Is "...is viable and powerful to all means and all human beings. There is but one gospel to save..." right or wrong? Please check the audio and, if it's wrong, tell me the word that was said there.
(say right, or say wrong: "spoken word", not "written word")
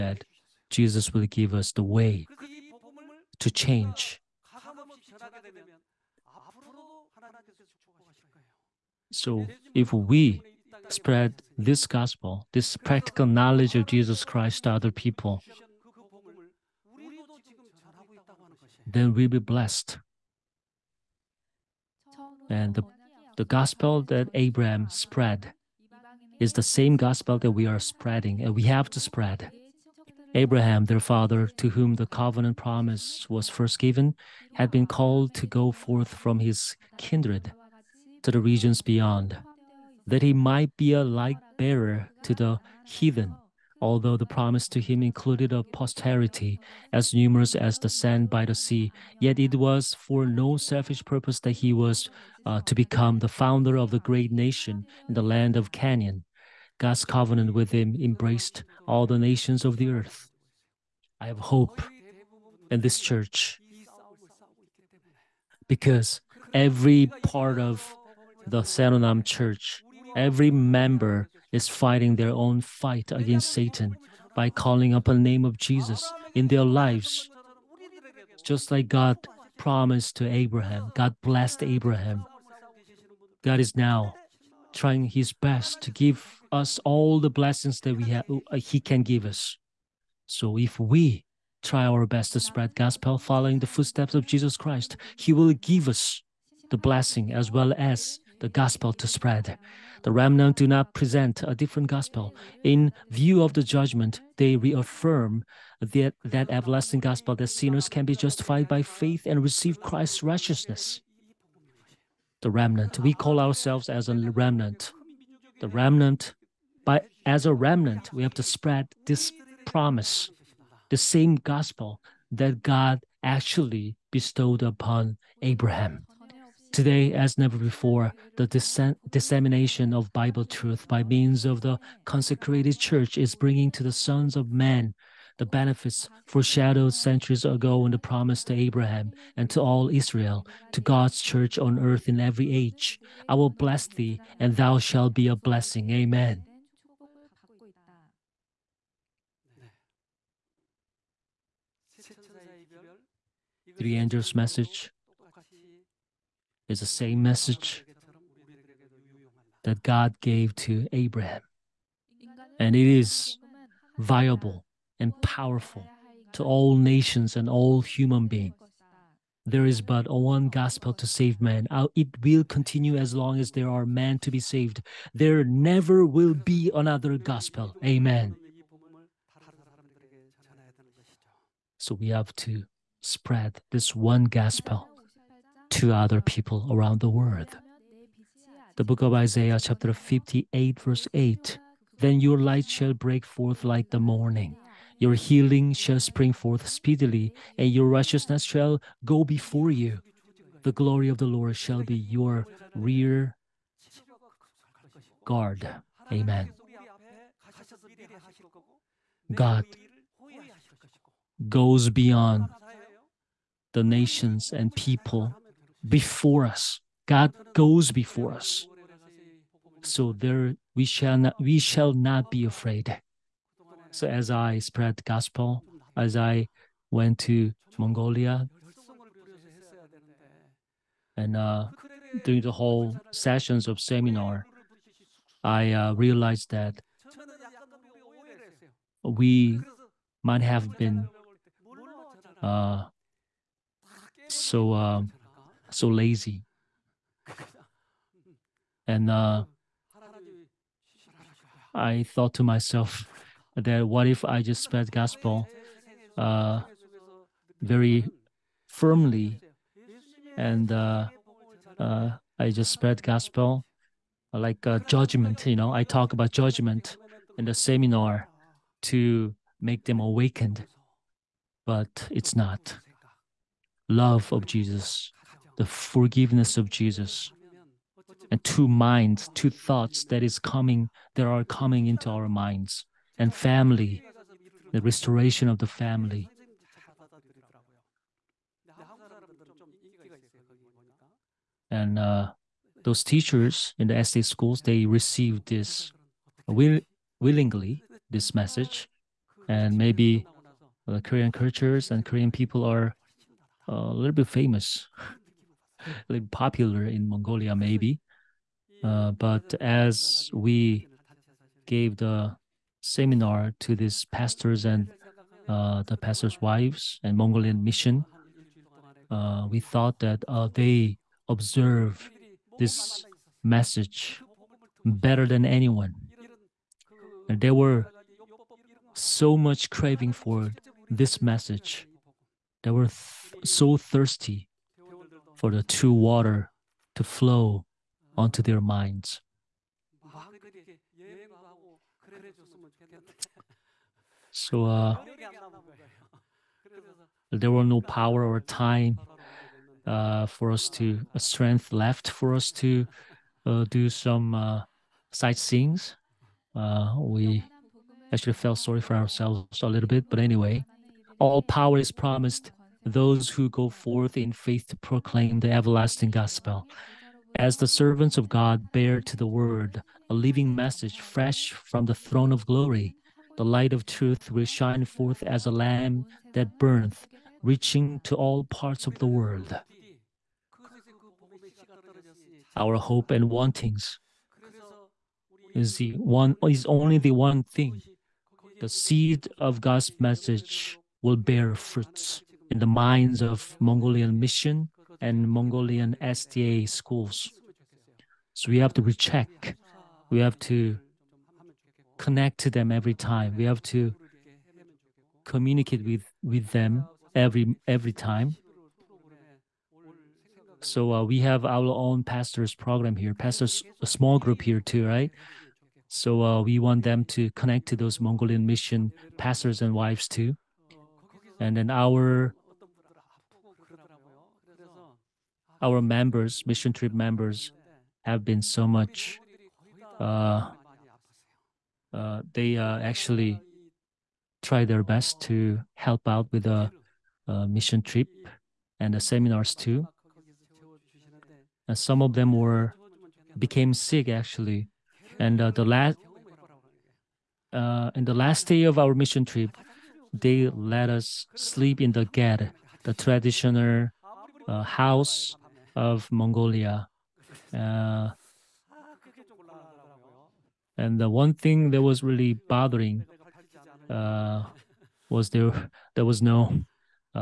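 wrong: "nations", not "means".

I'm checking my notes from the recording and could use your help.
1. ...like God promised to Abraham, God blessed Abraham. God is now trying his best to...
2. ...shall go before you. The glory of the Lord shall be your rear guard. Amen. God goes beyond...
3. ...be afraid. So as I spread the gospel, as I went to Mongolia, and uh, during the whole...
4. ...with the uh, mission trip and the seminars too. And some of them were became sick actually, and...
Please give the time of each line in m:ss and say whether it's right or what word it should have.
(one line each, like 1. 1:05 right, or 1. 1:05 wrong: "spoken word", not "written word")
1. 1:18 right
2. 3:18 right
3. 3:42 right
4. 7:16 right.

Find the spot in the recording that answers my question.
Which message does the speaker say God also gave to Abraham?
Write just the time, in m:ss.
2:33.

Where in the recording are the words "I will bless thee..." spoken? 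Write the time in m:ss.
2:23.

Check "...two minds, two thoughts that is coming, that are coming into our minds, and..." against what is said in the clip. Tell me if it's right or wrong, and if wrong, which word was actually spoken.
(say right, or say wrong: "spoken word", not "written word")
right.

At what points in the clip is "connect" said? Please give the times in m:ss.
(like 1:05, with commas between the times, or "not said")
6:41, 6:57.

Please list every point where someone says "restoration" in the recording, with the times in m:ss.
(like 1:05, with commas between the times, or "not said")
4:44.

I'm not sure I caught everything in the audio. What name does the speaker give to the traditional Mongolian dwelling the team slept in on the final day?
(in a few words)
ged.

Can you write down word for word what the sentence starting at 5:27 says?
And they were so much craving for this message.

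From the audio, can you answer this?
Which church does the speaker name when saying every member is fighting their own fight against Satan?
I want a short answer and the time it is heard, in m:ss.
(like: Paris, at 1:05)
Saeronam church, at 1:08.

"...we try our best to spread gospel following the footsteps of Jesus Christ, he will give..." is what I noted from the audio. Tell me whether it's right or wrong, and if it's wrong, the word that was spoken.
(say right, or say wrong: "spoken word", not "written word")
right.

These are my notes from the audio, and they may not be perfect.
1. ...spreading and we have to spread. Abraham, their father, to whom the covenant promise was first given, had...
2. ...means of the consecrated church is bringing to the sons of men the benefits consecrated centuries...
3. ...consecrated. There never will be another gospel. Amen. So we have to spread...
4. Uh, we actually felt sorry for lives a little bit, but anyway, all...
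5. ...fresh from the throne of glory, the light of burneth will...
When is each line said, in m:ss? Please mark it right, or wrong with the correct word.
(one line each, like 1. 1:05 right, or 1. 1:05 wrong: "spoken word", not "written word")
1. 0:27 right
2. 2:11 wrong: "foreshadowed", not "consecrated"
3. 2:54 wrong: "saved", not "consecrated"
4. 5:56 wrong: "ourselves", not "lives"
5. 6:10 wrong: "truth", not "burneth".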